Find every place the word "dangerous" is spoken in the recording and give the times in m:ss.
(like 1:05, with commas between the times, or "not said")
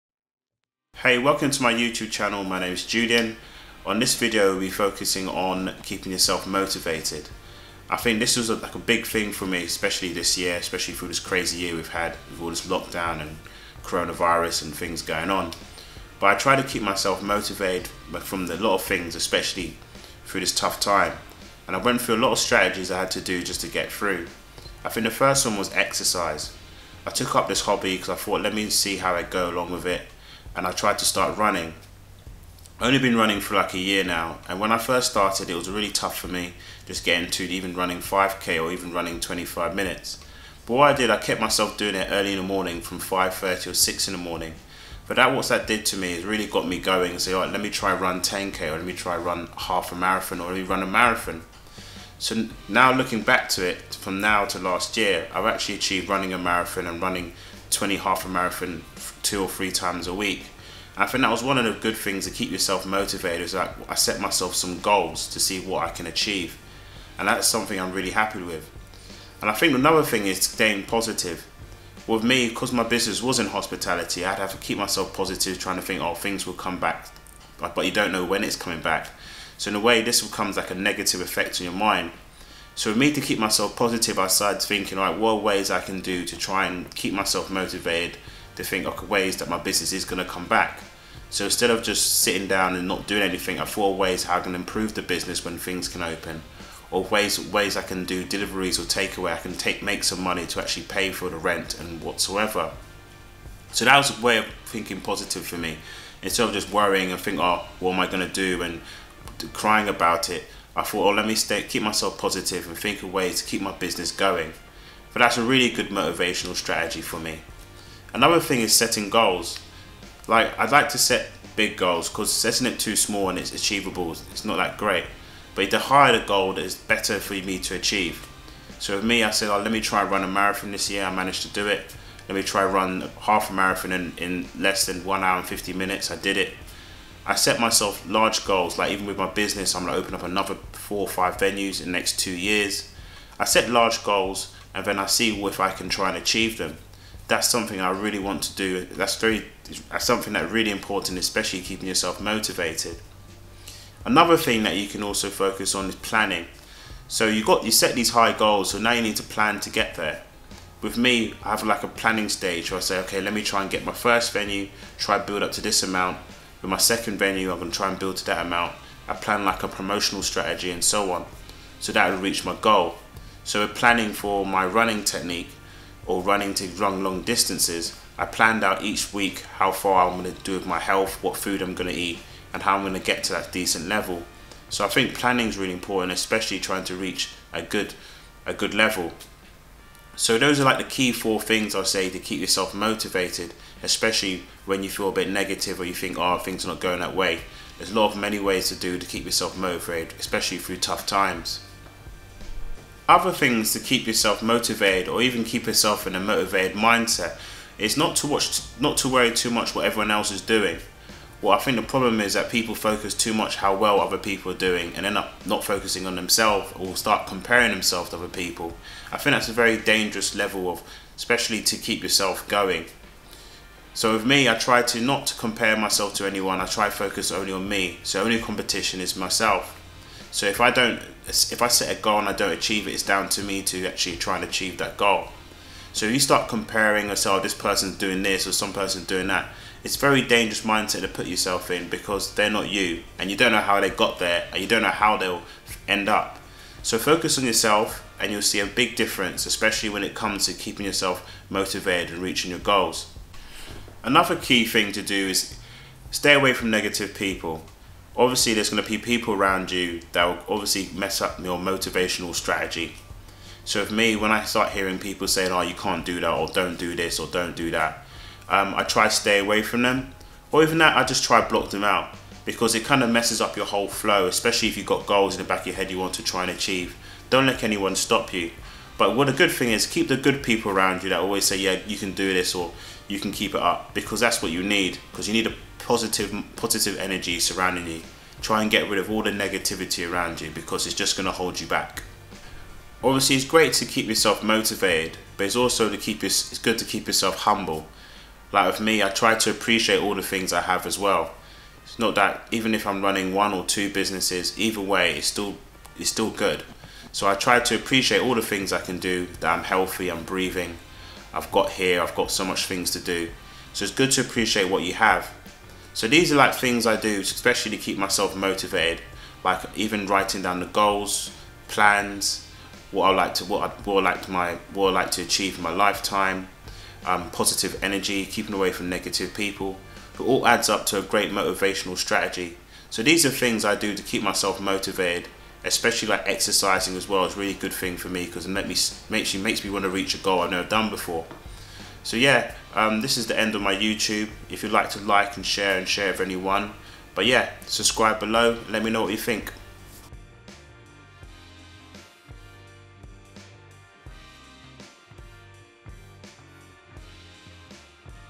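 3:39, 4:00.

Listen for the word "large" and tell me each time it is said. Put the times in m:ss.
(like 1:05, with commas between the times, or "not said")
2:18, 2:23.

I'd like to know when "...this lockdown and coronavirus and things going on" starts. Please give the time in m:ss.
0:12.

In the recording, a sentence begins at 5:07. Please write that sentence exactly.
So I try to appreciate all the things I can do.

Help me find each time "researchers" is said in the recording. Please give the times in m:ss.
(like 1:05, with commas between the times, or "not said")
not said.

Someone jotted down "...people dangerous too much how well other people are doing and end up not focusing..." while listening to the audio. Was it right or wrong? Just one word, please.
wrong.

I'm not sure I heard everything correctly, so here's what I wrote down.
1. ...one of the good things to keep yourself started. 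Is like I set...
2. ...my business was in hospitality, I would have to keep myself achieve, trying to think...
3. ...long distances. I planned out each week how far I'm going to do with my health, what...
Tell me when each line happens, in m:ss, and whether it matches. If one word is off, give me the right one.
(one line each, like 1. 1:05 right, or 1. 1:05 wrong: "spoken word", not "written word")
1. 1:01 wrong: "motivated", not "started"
2. 1:12 wrong: "positive", not "achieve"
3. 2:57 right.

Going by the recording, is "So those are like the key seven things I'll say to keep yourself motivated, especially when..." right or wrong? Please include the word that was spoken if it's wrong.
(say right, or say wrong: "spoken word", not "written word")
wrong: "four", not "seven".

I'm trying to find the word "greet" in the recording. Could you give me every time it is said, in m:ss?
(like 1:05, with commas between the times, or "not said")
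not said.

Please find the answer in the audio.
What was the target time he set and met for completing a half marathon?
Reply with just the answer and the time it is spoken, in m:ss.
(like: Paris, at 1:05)
1 hour 50 minutes, at 2:15.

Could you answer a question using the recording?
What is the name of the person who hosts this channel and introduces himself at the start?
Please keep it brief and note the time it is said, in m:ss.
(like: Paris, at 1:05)
Julian, at 0:02.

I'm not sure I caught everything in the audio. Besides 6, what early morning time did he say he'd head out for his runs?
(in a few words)
5:30.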